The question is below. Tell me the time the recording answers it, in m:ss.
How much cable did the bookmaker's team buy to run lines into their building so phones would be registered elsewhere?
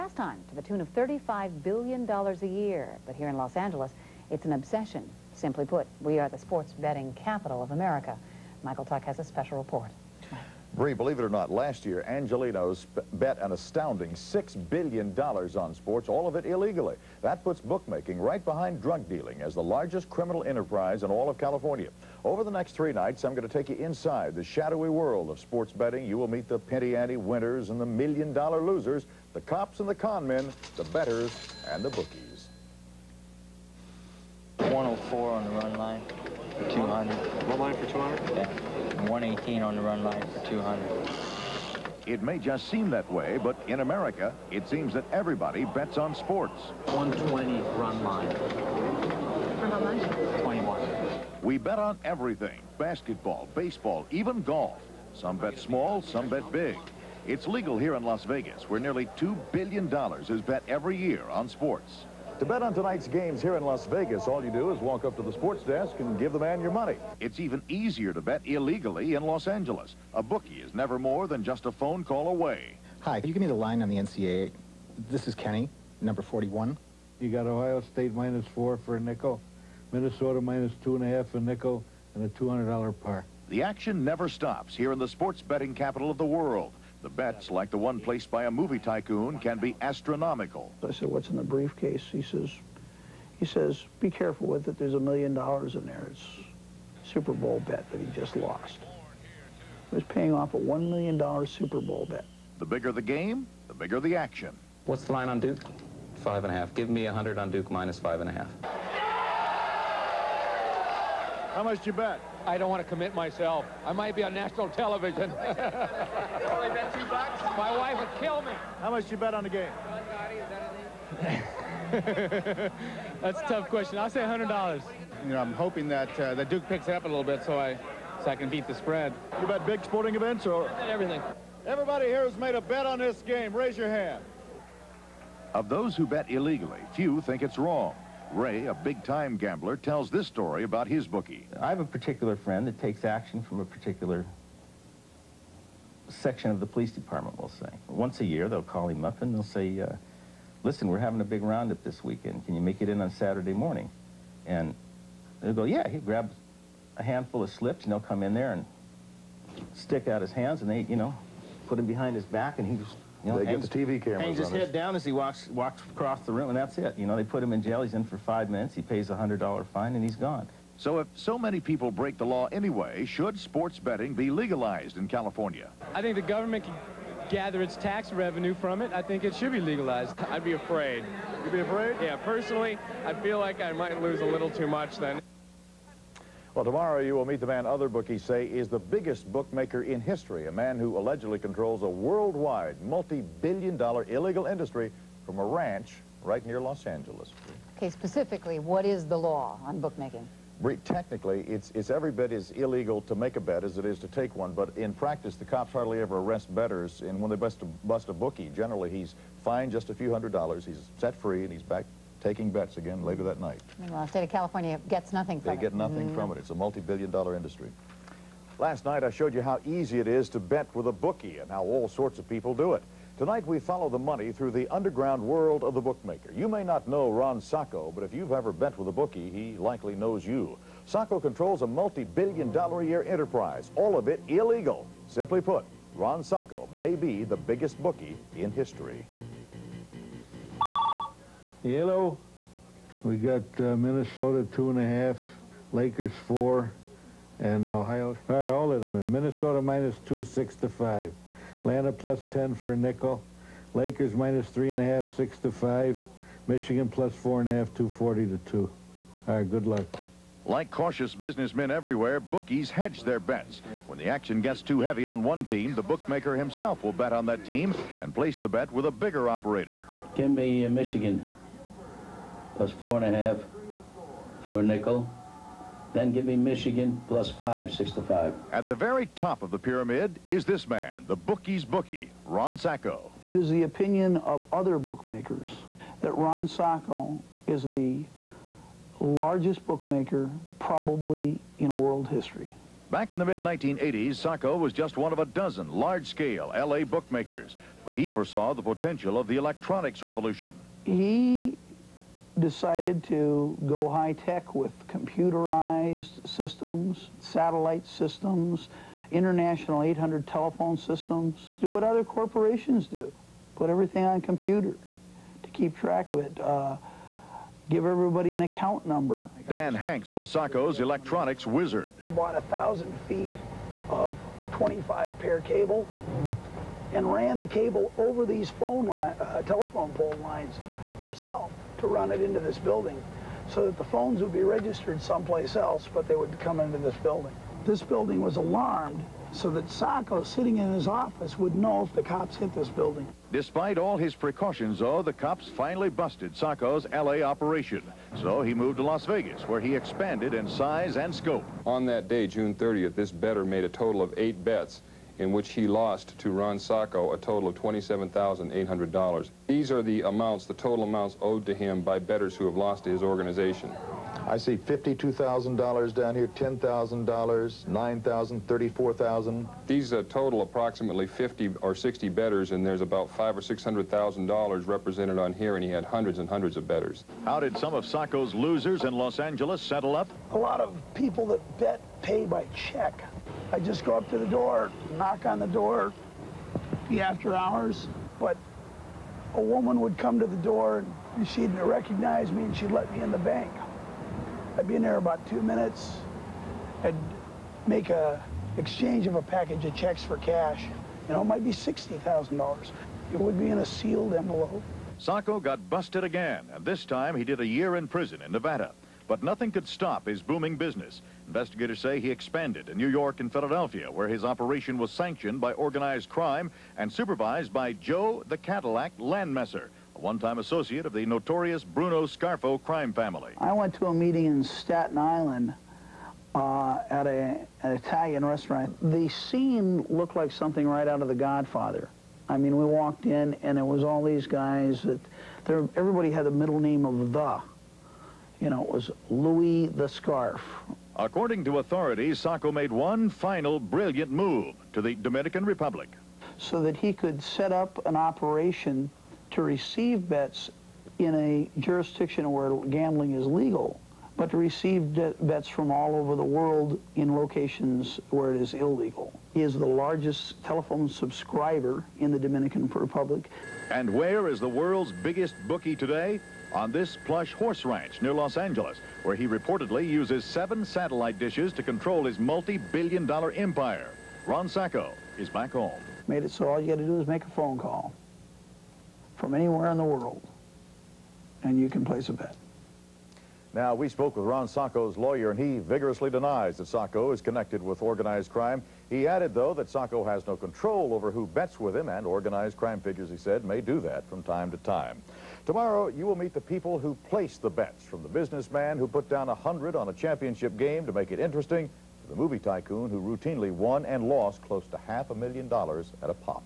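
5:22.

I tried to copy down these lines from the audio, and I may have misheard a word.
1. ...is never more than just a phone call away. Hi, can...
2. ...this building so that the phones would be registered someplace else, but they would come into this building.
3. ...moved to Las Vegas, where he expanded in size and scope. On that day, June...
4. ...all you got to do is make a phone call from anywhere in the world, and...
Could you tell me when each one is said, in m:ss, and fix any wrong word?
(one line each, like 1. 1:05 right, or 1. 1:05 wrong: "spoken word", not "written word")
1. 1:10 right
2. 5:32 right
3. 5:48 right
4. 7:56 right.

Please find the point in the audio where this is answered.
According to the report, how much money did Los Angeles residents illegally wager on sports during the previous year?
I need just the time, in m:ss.
0:14.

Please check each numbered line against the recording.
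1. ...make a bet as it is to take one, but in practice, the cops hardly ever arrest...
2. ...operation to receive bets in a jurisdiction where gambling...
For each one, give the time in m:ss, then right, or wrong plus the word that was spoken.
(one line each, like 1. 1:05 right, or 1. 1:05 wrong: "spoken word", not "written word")
1. 3:23 right
2. 7:27 right.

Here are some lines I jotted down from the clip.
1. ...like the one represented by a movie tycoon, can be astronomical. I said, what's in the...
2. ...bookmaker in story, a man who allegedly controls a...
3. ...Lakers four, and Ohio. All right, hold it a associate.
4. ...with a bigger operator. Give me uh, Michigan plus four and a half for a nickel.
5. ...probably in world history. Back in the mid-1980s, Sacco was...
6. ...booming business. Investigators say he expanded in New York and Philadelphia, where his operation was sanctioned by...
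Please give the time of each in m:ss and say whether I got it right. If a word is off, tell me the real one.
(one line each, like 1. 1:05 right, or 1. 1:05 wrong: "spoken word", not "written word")
1. 1:27 wrong: "placed", not "represented"
2. 3:09 wrong: "history", not "story"
3. 4:05 wrong: "minute", not "associate"
4. 4:28 right
5. 4:50 right
6. 6:50 right.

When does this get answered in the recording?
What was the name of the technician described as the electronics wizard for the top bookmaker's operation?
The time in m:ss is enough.
5:19.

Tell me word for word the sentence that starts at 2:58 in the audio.
I think it should be legalized.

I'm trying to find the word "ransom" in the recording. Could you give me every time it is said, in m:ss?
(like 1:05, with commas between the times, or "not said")
not said.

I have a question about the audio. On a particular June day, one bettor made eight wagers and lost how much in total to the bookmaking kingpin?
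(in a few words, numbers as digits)
$27,800.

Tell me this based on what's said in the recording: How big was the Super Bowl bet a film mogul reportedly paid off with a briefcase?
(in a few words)
$1 million.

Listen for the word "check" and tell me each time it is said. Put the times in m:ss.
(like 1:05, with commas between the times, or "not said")
6:22, 6:39.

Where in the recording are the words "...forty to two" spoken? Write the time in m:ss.
4:17.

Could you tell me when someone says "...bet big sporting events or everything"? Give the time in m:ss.
2:09.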